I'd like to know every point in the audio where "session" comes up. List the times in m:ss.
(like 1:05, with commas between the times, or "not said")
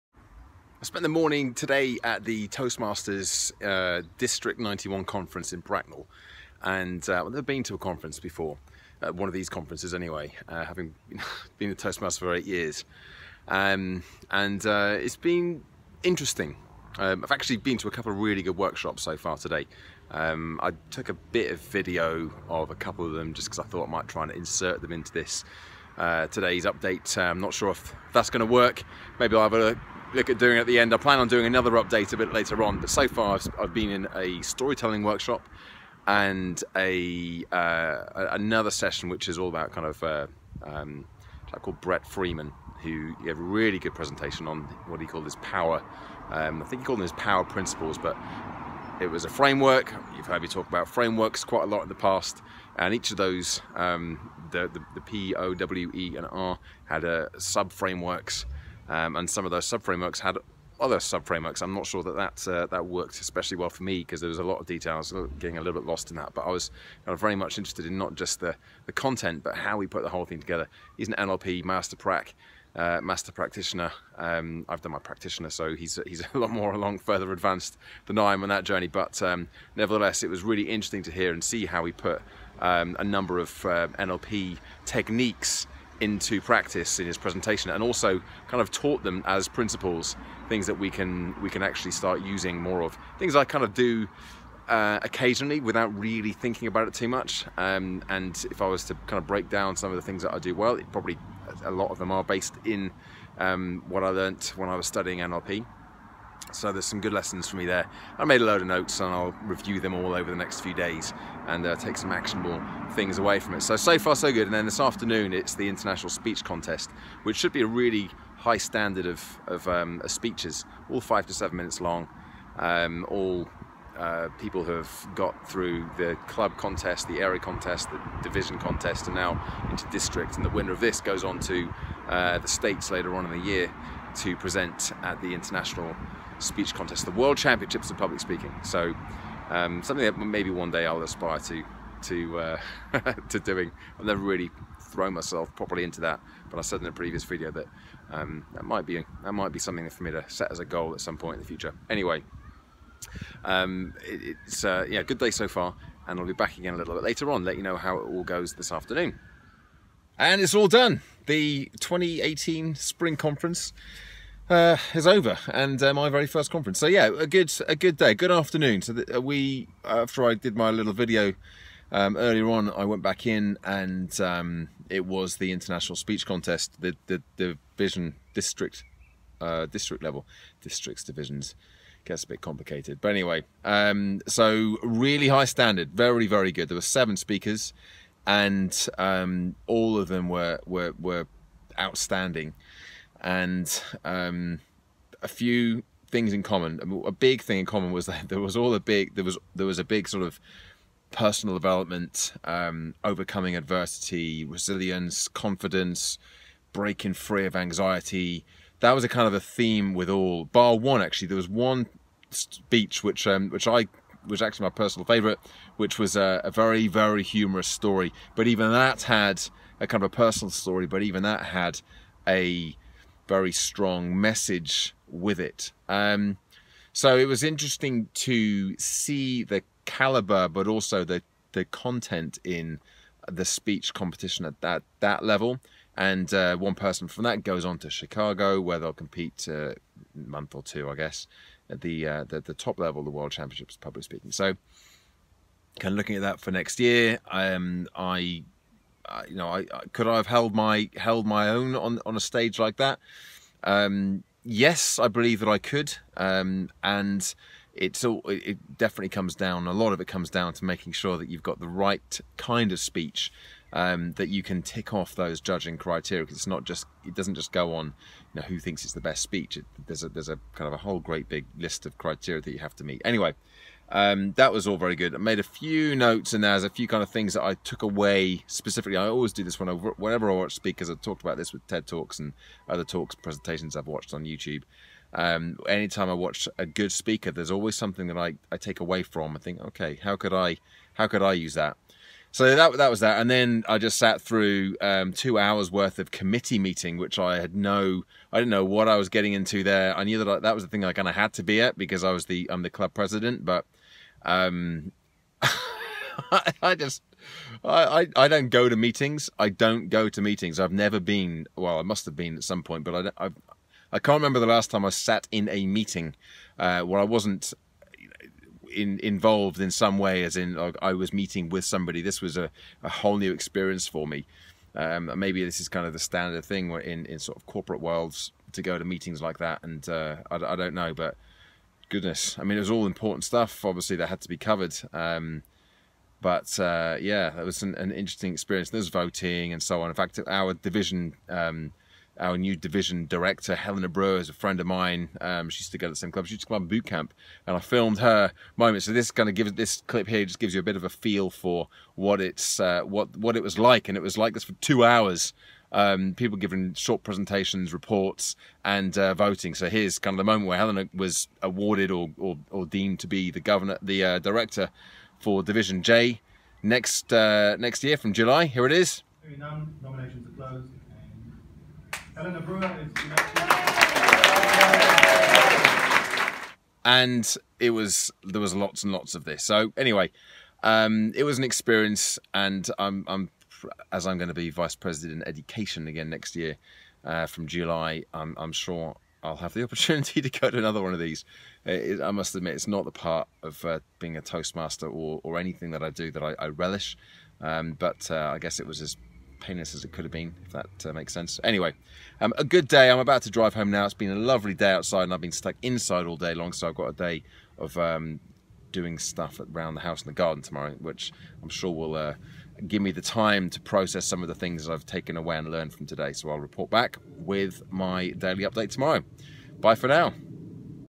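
0:38.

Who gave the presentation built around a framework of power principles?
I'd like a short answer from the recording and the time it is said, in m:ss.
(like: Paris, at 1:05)
Brett Freeman, at 0:41.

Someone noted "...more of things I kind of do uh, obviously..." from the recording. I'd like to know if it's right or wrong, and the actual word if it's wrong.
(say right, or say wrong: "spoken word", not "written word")
wrong: "occasionally", not "obviously".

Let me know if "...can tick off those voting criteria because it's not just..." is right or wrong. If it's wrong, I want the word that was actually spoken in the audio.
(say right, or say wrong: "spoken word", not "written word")
wrong: "judging", not "voting".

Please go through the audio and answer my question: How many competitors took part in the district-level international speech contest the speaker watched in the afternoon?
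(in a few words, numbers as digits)
7.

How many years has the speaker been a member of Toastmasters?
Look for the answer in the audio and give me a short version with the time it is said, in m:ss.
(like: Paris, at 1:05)
8, at 0:12.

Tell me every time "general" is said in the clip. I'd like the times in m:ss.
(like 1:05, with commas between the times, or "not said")
not said.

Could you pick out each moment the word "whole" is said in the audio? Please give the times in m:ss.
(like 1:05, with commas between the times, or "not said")
1:10, 4:30, 5:22.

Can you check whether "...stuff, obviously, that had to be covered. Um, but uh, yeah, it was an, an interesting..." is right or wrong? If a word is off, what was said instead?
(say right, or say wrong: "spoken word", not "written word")
right.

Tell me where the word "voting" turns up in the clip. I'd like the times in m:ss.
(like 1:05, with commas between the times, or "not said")
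5:38, 5:59.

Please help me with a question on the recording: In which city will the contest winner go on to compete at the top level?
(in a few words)
Chicago.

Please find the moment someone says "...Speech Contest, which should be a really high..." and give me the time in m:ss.
1:56.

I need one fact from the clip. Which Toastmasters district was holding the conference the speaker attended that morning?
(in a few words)
District 91.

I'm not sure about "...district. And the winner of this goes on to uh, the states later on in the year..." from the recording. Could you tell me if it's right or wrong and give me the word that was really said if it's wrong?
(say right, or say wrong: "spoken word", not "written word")
right.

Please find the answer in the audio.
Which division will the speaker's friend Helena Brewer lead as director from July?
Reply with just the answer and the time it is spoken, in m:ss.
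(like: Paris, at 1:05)
Division J, at 6:05.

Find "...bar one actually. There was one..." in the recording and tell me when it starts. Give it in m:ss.
3:30.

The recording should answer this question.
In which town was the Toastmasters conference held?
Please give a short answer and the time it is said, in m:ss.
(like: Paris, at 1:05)
Bracknell, at 0:05.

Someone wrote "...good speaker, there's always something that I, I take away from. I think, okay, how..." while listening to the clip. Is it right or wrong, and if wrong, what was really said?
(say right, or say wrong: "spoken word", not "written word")
right.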